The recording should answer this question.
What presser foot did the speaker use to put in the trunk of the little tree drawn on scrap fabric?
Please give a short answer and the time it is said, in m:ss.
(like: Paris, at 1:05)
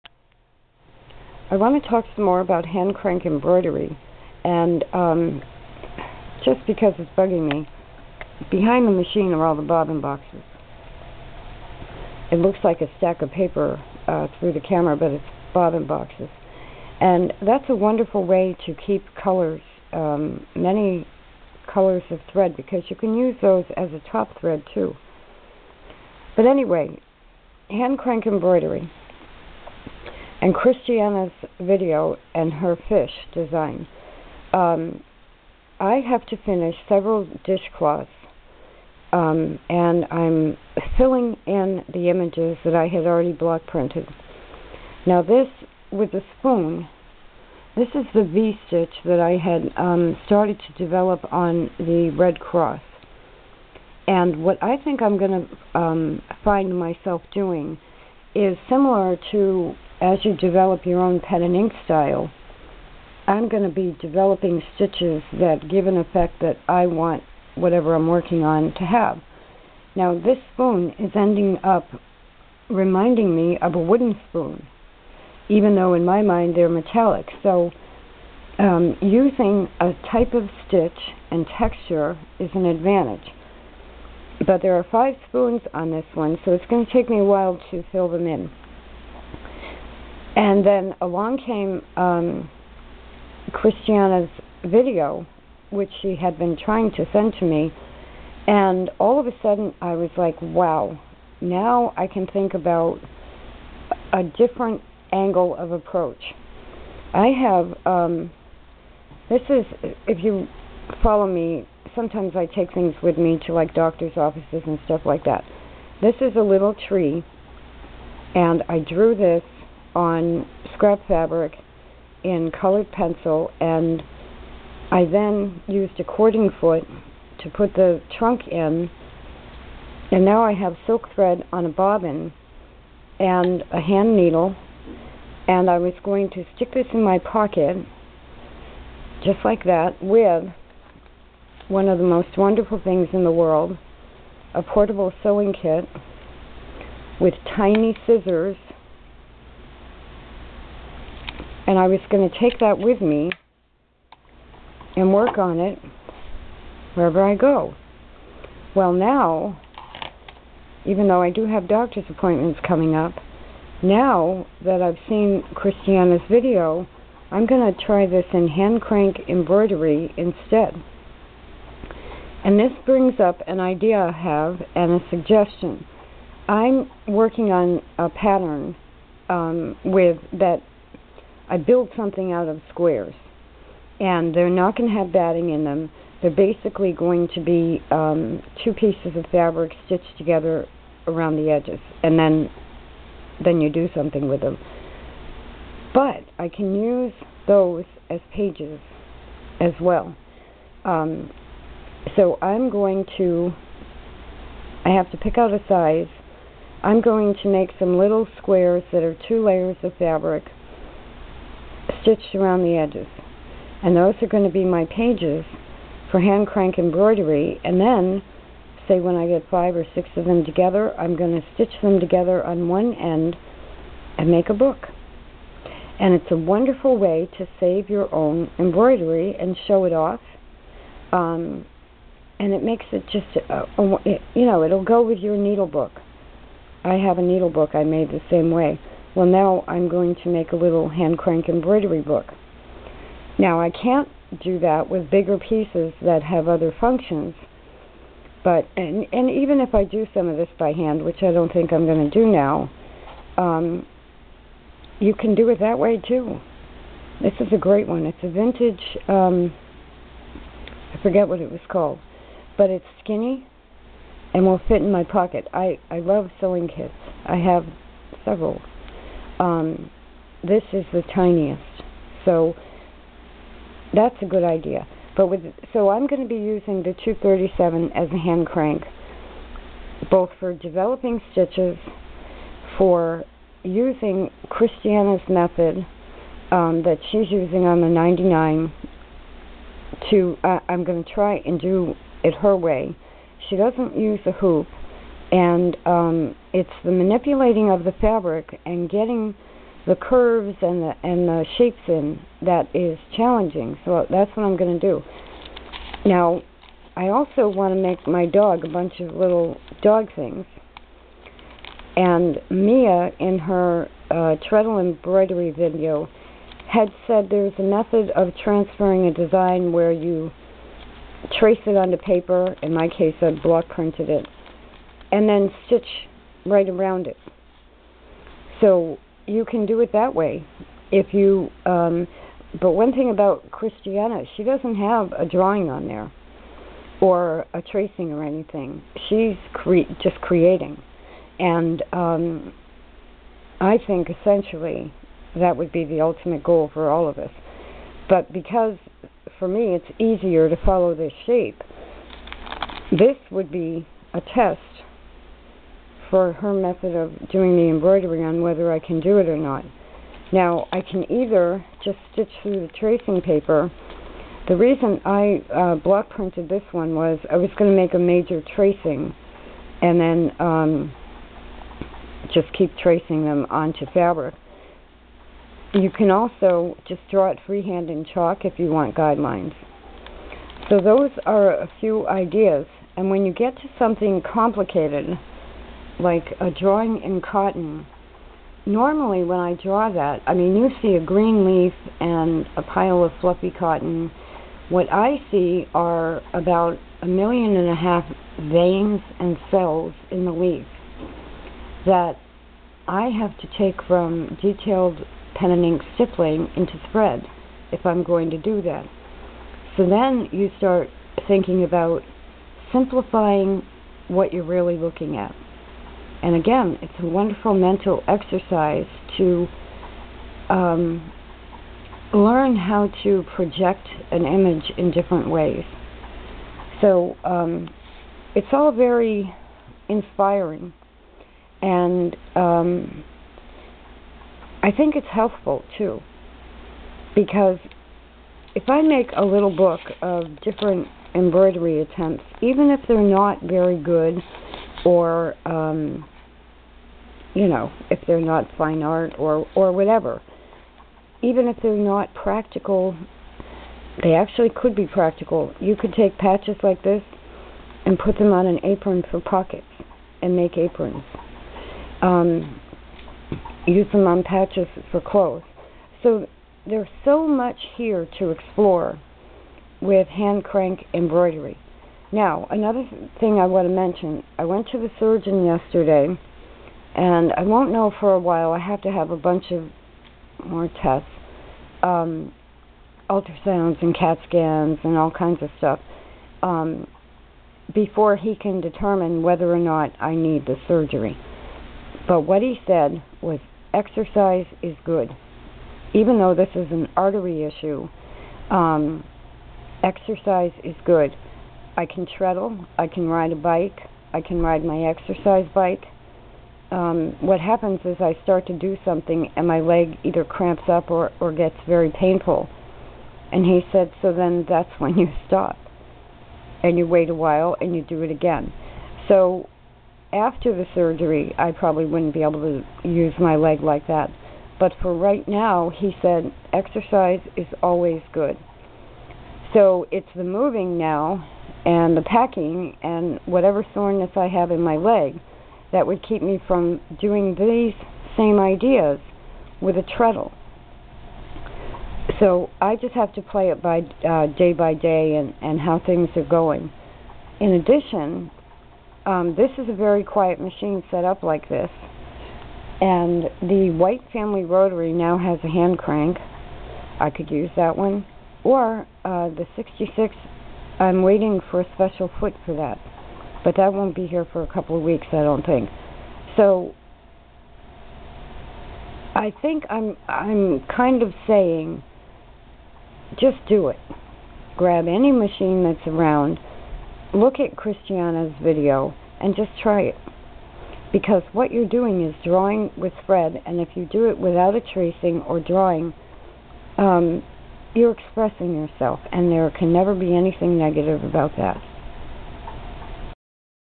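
Cording foot, at 2:06.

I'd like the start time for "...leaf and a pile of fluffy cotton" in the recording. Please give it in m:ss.
6:31.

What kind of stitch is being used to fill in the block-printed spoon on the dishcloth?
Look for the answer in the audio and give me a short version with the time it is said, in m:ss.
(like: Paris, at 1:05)
V-stitch, at 0:48.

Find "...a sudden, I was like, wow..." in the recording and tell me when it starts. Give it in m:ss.
1:39.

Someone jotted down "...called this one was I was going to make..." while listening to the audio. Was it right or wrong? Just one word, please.
wrong.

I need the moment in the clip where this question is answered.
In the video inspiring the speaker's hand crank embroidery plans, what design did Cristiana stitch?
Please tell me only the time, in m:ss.
0:32.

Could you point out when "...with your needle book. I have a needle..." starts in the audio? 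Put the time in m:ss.
3:55.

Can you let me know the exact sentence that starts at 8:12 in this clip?
But what he said was exercise is good.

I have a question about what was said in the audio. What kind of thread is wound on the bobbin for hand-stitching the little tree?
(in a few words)
Silk.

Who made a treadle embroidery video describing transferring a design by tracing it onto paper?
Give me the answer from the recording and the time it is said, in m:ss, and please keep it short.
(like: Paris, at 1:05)
Mia, at 5:12.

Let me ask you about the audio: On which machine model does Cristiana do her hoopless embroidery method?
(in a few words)
99.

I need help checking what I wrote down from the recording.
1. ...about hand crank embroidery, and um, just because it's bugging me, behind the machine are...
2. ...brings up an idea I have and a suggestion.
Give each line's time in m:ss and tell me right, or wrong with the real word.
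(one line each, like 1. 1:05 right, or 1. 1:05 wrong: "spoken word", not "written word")
1. 0:02 right
2. 2:52 right.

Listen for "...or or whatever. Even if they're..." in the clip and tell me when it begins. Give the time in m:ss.
7:29.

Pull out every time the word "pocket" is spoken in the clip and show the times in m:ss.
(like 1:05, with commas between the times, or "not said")
2:17, 4:25, 7:39.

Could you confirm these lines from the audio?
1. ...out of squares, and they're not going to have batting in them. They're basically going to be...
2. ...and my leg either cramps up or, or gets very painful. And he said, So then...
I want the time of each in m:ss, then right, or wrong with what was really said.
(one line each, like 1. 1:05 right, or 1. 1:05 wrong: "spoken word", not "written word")
1. 3:02 right
2. 8:29 right.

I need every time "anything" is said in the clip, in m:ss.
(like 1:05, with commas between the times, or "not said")
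5:38, 9:50.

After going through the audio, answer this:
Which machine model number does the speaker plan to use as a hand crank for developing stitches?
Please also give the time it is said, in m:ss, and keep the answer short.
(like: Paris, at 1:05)
237, at 4:37.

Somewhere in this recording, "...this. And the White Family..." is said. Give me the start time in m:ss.
9:11.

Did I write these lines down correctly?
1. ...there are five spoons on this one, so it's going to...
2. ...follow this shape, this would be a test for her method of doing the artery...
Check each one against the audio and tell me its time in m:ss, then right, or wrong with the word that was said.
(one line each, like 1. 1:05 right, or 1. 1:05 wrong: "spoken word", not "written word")
1. 1:24 right
2. 5:50 wrong: "embroidery", not "artery".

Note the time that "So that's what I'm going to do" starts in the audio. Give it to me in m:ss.
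5:03.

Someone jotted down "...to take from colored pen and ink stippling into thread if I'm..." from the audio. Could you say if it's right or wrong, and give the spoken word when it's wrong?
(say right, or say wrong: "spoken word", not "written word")
wrong: "detailed", not "colored".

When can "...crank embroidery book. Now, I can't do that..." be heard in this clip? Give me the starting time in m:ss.
4:01.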